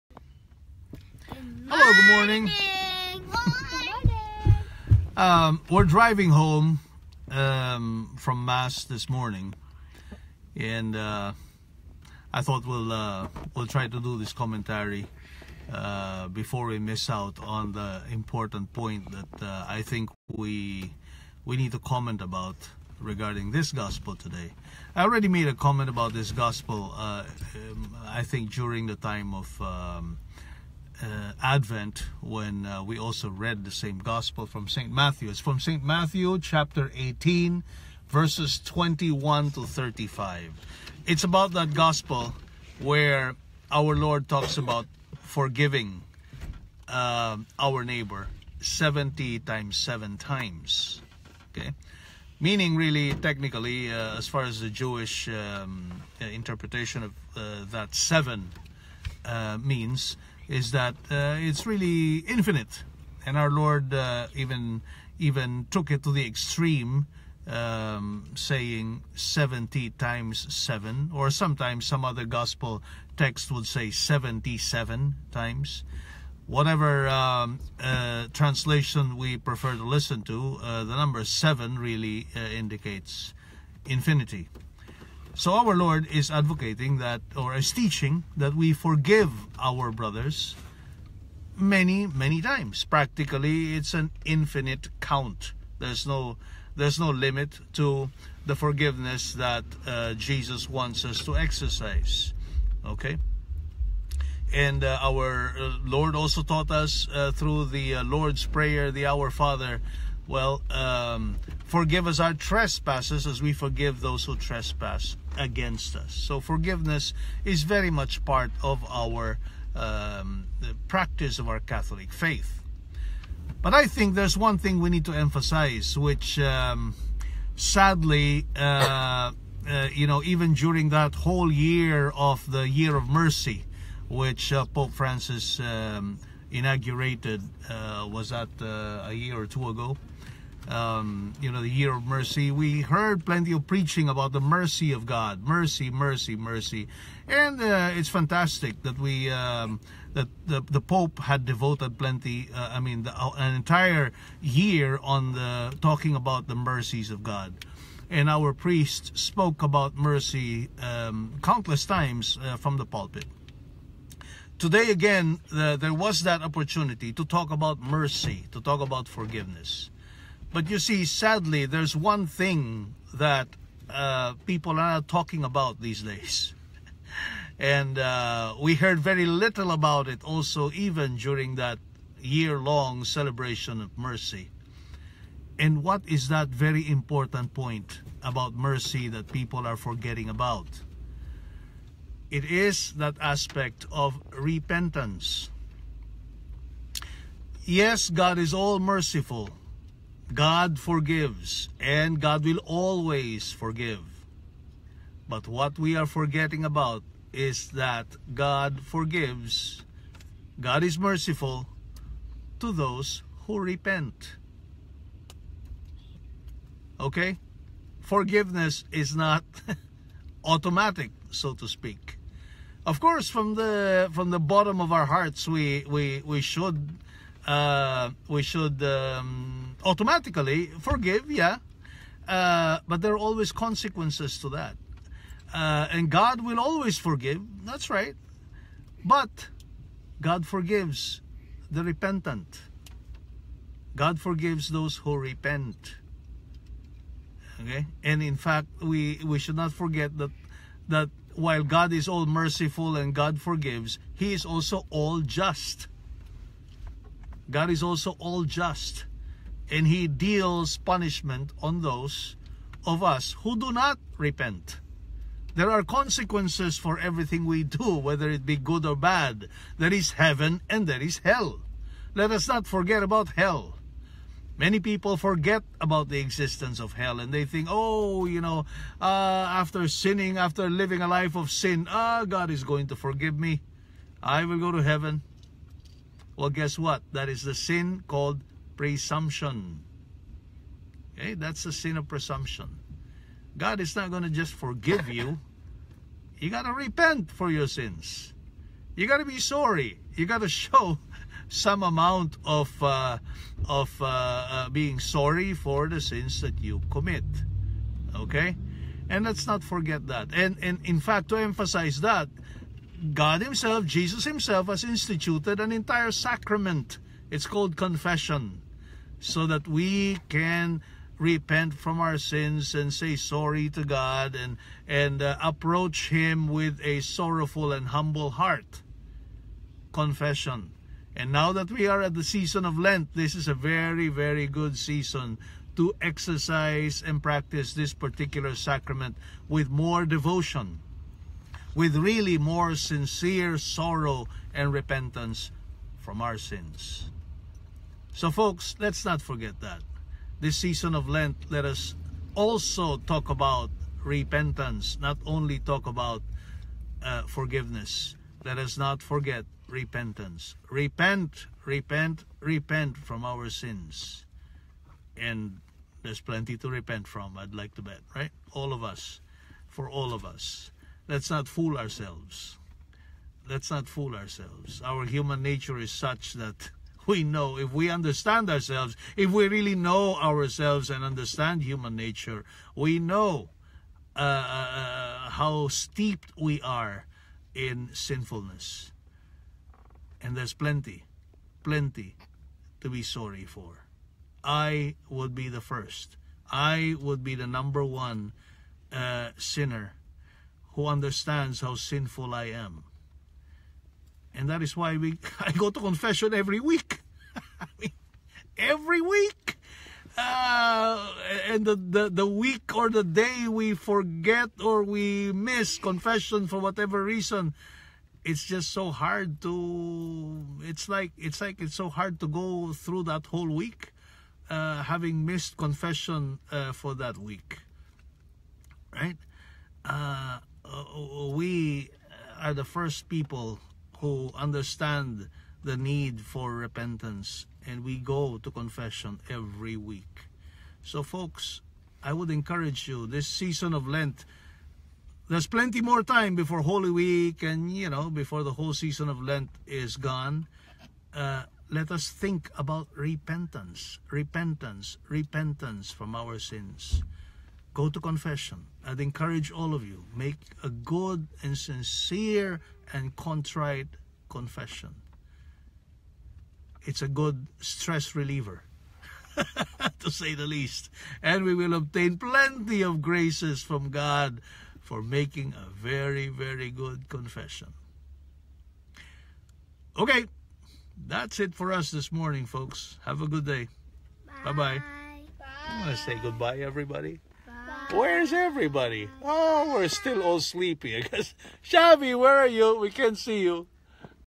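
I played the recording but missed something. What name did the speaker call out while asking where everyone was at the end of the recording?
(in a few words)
Shabby.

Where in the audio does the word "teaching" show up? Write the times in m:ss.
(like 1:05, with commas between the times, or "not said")
1:27.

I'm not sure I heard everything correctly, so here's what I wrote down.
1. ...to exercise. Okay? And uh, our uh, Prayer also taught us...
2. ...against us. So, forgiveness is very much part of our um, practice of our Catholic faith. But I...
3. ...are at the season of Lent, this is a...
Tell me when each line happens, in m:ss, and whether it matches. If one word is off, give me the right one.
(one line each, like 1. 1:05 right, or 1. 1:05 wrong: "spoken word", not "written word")
1. 1:41 wrong: "Lord", not "Prayer"
2. 1:55 right
3. 5:31 right.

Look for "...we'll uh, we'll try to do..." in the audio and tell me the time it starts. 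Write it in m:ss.
0:12.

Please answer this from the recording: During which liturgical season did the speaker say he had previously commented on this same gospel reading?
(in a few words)
Advent.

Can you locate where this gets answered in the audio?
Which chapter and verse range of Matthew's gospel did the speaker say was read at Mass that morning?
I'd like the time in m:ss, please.
0:36.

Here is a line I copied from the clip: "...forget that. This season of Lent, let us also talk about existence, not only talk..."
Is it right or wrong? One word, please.
wrong.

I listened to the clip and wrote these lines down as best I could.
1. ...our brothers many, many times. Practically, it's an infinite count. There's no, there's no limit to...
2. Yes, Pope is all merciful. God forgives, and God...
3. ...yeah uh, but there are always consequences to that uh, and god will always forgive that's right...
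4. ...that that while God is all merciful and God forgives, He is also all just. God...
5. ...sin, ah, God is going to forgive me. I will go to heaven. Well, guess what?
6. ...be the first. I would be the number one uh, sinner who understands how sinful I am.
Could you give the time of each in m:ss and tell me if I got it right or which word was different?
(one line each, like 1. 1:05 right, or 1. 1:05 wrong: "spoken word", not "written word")
1. 1:29 right
2. 3:17 wrong: "God", not "Pope"
3. 3:51 right
4. 4:10 right
5. 4:41 right
6. 6:35 right.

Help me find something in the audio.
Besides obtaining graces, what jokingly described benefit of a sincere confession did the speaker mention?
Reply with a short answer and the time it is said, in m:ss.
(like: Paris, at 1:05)
Stress reliever, at 7:47.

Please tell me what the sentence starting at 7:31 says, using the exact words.
Uh, let us think about repentance, repentance, repentance from our sins.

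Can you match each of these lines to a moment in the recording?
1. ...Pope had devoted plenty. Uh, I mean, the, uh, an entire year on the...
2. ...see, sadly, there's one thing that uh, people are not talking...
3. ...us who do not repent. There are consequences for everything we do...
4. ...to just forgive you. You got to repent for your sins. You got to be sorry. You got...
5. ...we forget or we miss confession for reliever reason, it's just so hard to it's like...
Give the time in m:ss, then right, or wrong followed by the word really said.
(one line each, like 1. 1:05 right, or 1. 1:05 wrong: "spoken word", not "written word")
1. 2:30 right
2. 2:50 right
3. 4:23 right
4. 4:54 right
5. 6:53 wrong: "whatever", not "reliever".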